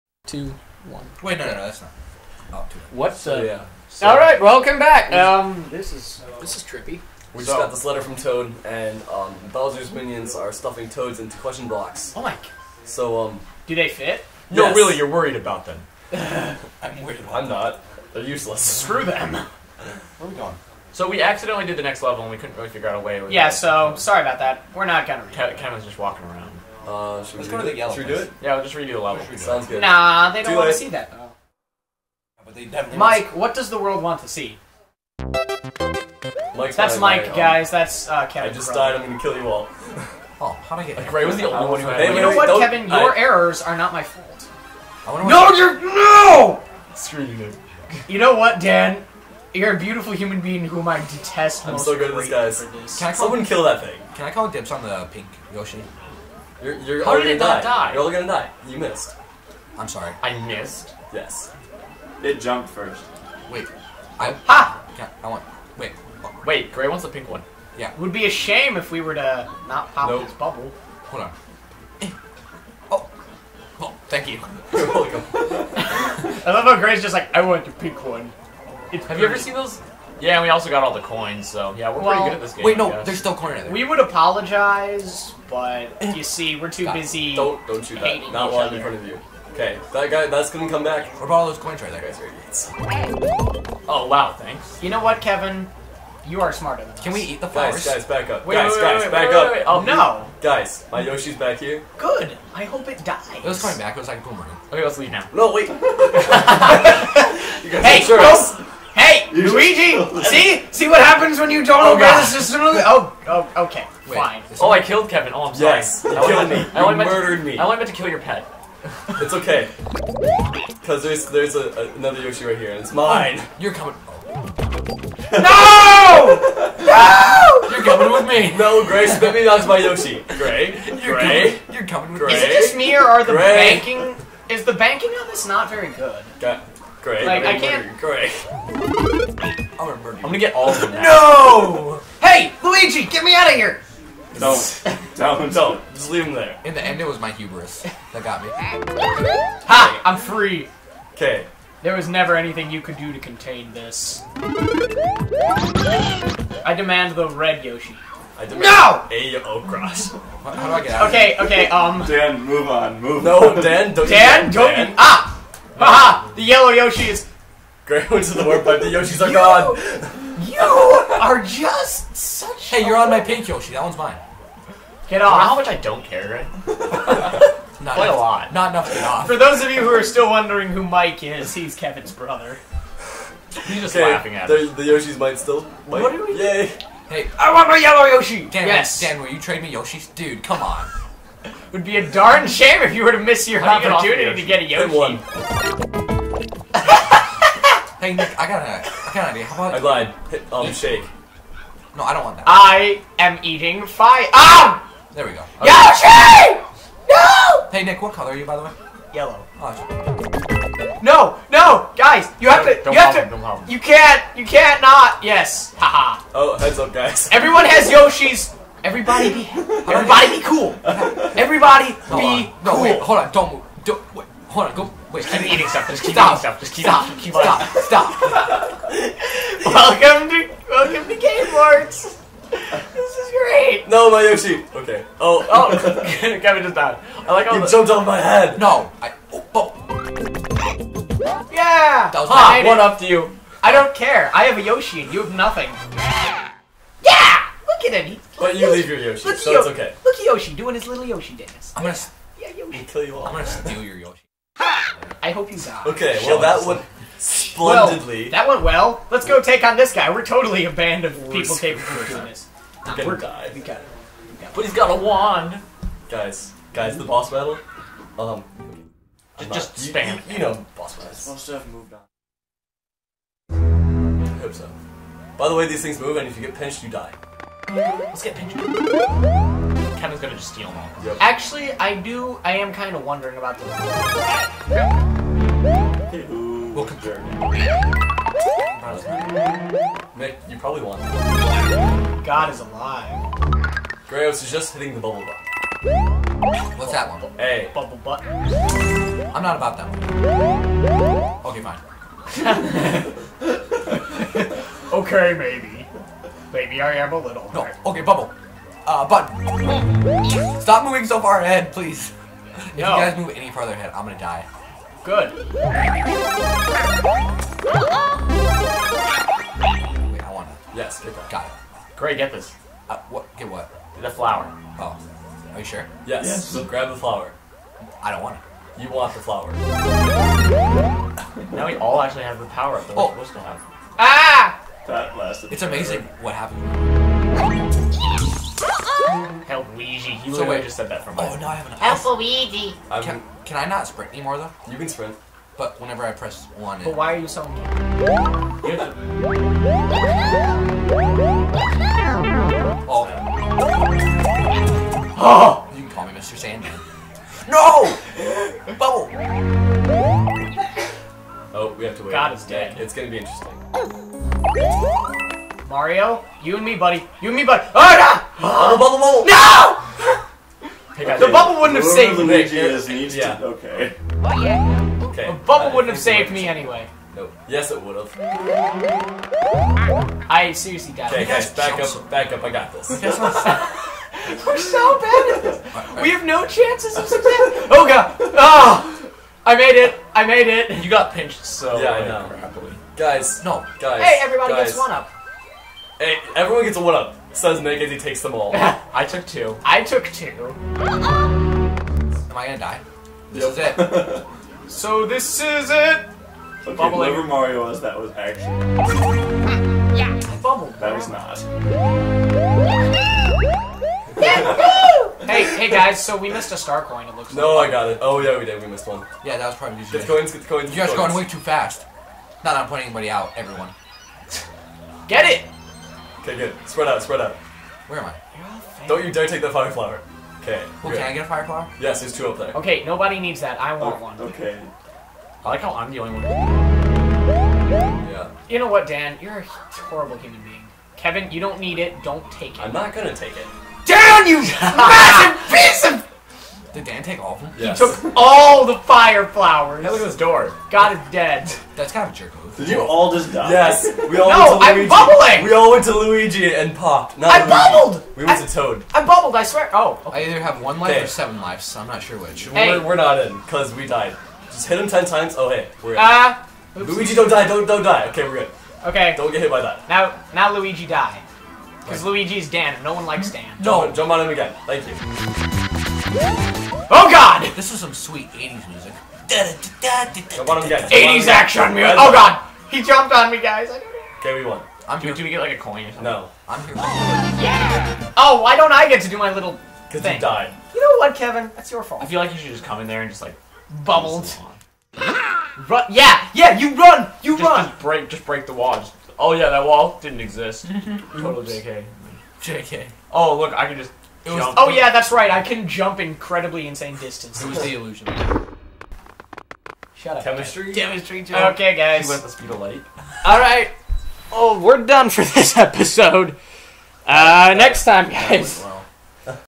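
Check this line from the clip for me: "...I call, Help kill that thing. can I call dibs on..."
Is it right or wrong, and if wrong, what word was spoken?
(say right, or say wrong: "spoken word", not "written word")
wrong: "Someone", not "Help".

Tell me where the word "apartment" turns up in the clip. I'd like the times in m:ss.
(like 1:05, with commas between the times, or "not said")
not said.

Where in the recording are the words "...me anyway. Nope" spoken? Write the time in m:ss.
6:16.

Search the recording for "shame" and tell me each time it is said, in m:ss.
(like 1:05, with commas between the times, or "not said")
1:08, 3:12.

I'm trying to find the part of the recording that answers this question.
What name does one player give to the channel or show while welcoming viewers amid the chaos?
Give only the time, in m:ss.
3:51.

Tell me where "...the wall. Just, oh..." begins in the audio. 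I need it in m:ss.
8:18.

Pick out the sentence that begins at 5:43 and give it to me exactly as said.
Can, can I not sprint anymore, though?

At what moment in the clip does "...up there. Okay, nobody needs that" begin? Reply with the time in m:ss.
7:12.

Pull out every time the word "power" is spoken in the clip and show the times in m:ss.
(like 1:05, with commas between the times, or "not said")
5:32.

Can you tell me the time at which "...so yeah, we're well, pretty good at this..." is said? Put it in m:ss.
1:21.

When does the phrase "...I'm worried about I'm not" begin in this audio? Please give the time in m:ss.
0:16.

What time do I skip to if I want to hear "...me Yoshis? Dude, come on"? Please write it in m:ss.
3:09.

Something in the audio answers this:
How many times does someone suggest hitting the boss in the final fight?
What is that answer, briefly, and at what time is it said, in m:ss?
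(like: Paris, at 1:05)
10, at 7:44.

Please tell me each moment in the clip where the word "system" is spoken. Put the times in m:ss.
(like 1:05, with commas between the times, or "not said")
1:52.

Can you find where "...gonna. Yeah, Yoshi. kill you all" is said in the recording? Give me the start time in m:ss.
4:11.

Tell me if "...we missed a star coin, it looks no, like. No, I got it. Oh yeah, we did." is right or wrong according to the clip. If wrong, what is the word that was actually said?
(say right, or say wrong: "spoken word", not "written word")
right.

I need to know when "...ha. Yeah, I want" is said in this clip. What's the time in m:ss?
1:04.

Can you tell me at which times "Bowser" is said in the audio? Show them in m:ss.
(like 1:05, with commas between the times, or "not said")
0:09.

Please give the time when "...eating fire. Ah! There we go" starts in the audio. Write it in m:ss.
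3:23.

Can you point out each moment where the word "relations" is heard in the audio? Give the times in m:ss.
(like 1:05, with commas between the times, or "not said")
not said.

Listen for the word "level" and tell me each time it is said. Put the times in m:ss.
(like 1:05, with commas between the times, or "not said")
0:22, 0:28.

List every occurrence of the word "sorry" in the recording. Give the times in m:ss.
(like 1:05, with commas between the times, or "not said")
0:23, 0:59, 1:55.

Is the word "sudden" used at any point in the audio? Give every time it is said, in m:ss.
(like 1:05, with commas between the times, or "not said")
not said.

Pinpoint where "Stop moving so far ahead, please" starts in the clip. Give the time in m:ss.
5:10.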